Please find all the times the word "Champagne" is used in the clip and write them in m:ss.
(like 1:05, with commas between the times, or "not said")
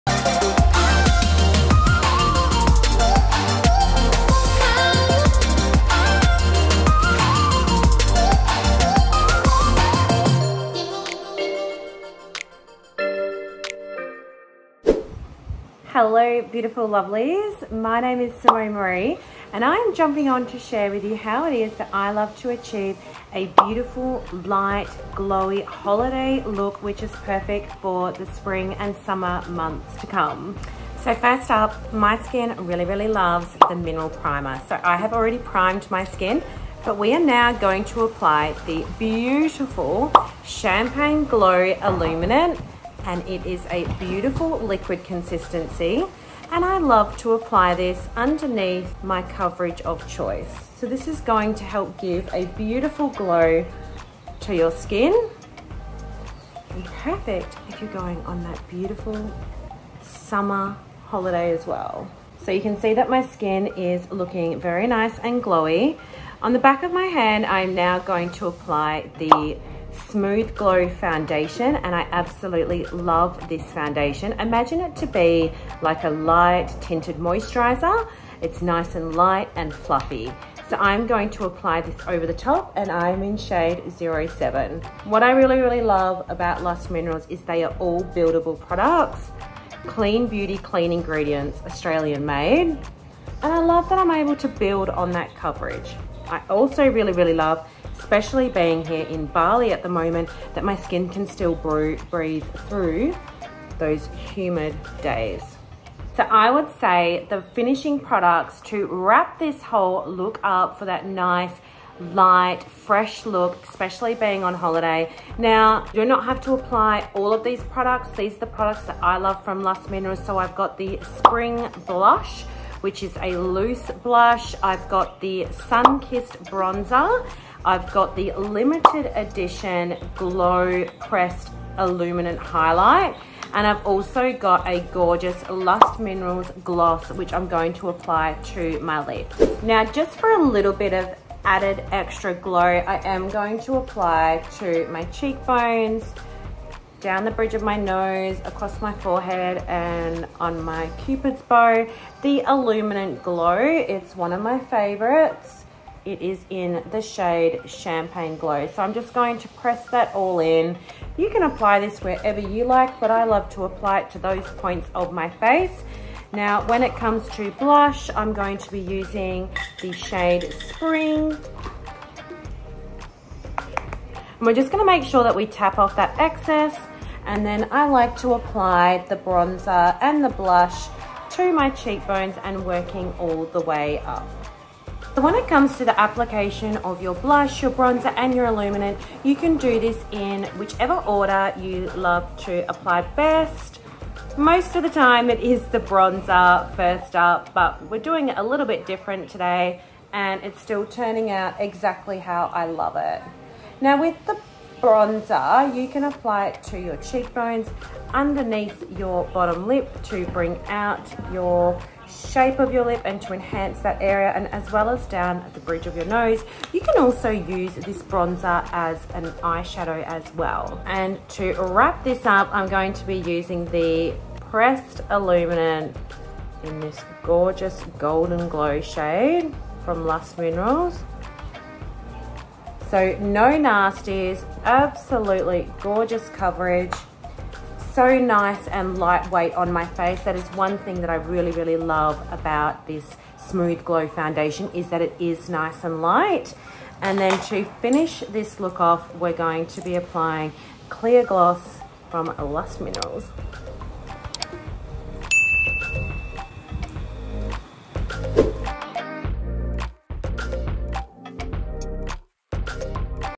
0:40, 2:37.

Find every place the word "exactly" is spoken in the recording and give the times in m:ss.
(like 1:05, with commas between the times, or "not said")
3:21.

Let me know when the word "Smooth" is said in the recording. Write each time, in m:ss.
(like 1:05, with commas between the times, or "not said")
1:10, 4:03.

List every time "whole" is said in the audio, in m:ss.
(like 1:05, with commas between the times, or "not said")
1:49.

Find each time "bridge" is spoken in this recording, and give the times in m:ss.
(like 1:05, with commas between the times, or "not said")
2:27, 3:35.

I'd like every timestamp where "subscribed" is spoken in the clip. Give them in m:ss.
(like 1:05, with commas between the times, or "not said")
not said.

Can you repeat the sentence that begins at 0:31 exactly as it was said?
So first up, my skin really, really loves the mineral primer.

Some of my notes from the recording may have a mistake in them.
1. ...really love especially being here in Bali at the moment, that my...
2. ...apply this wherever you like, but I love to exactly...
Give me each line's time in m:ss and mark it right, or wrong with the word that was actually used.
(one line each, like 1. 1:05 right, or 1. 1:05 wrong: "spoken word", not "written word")
1. 1:37 right
2. 2:41 wrong: "apply", not "exactly".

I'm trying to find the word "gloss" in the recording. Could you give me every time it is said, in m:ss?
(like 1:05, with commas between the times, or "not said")
2:16, 4:11.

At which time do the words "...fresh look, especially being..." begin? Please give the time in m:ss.
1:52.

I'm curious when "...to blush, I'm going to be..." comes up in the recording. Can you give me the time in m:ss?
2:47.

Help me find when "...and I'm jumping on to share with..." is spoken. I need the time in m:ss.
0:19.